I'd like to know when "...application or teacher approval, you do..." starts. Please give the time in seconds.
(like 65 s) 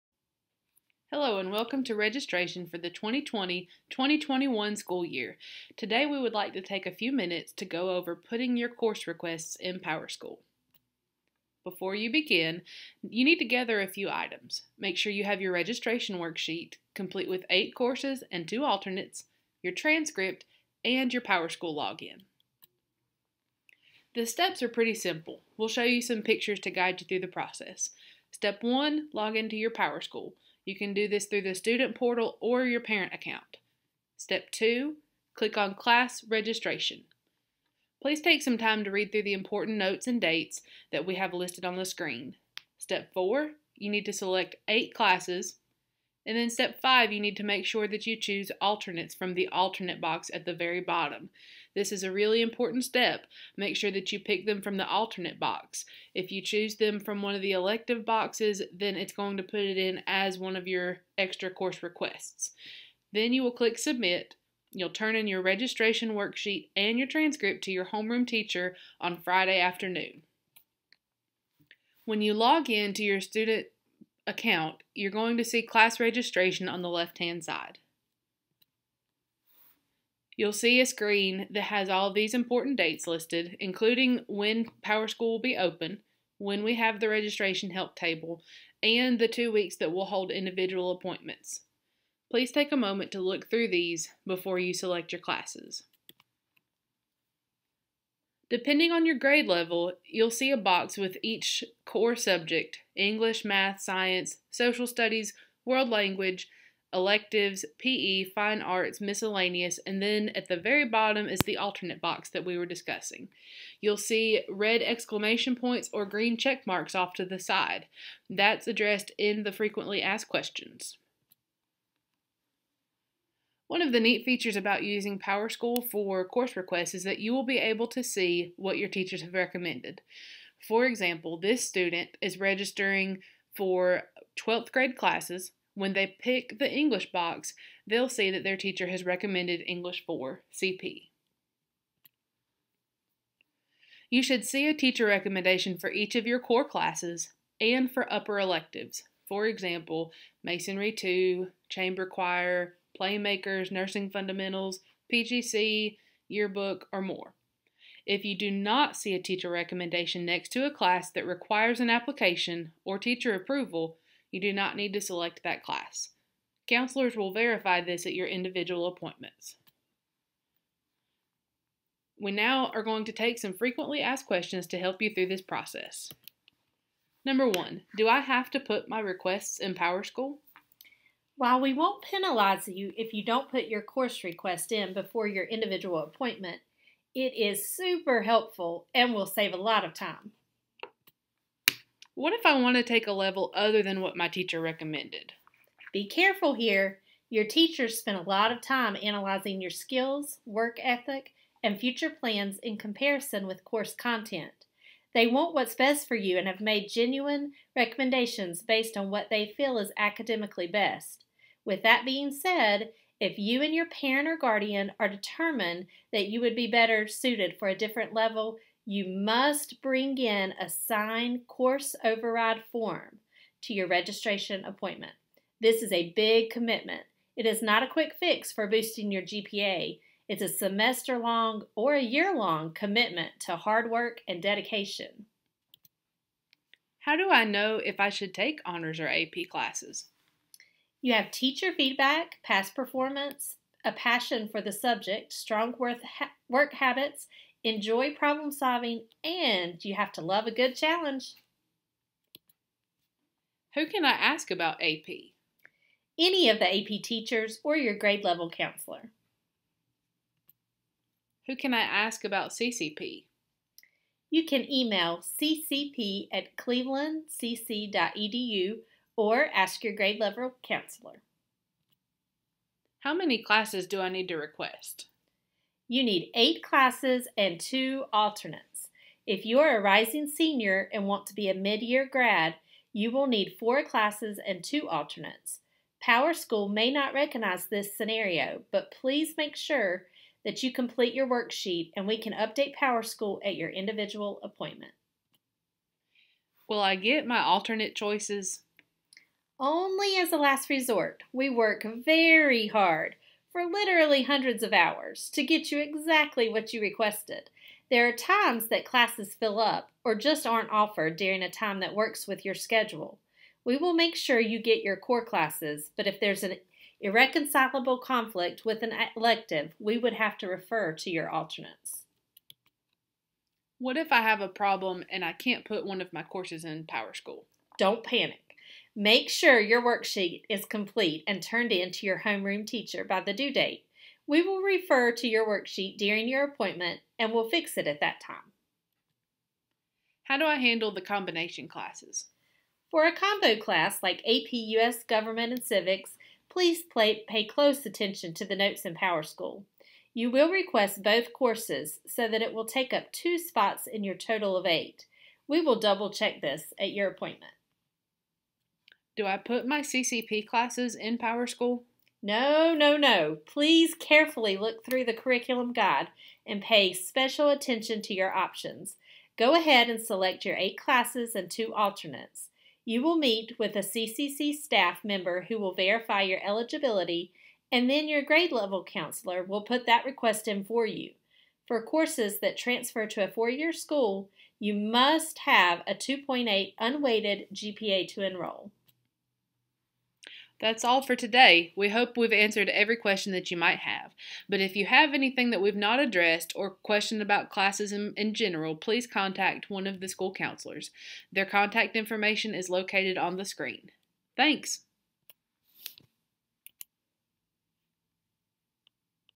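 161 s.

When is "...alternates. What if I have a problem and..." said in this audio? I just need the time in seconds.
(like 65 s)
321 s.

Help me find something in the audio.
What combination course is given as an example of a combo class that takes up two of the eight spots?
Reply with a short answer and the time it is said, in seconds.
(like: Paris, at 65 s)
AP US Government and Civics, at 344 s.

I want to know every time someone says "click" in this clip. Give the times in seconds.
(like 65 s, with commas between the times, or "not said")
35 s, 63 s.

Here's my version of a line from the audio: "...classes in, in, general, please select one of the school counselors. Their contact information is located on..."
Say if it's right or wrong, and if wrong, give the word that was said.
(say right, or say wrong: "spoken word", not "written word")
wrong: "contact", not "select".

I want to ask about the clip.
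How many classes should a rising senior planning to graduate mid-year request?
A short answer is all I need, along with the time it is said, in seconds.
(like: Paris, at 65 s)
4, at 283 s.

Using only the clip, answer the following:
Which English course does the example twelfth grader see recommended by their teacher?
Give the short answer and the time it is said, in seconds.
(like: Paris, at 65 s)
English 4 CP, at 139 s.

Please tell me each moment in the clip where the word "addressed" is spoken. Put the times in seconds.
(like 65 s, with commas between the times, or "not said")
118 s, 395 s.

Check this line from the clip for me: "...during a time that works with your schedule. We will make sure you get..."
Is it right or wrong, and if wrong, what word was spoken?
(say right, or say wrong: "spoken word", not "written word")
right.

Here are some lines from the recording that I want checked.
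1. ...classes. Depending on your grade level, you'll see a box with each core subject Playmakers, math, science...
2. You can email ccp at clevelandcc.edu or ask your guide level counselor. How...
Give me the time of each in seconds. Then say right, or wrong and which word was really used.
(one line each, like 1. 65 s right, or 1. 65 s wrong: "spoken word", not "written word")
1. 95 s wrong: "English", not "Playmakers"
2. 264 s wrong: "grade", not "guide".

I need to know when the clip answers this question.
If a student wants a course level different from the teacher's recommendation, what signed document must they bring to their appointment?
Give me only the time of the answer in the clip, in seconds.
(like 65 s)
221 s.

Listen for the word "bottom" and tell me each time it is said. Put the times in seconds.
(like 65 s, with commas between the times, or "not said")
50 s, 110 s.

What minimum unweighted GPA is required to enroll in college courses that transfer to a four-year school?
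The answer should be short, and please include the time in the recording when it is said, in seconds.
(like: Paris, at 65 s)
2.8, at 385 s.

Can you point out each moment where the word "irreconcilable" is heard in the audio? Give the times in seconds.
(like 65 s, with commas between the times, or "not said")
316 s.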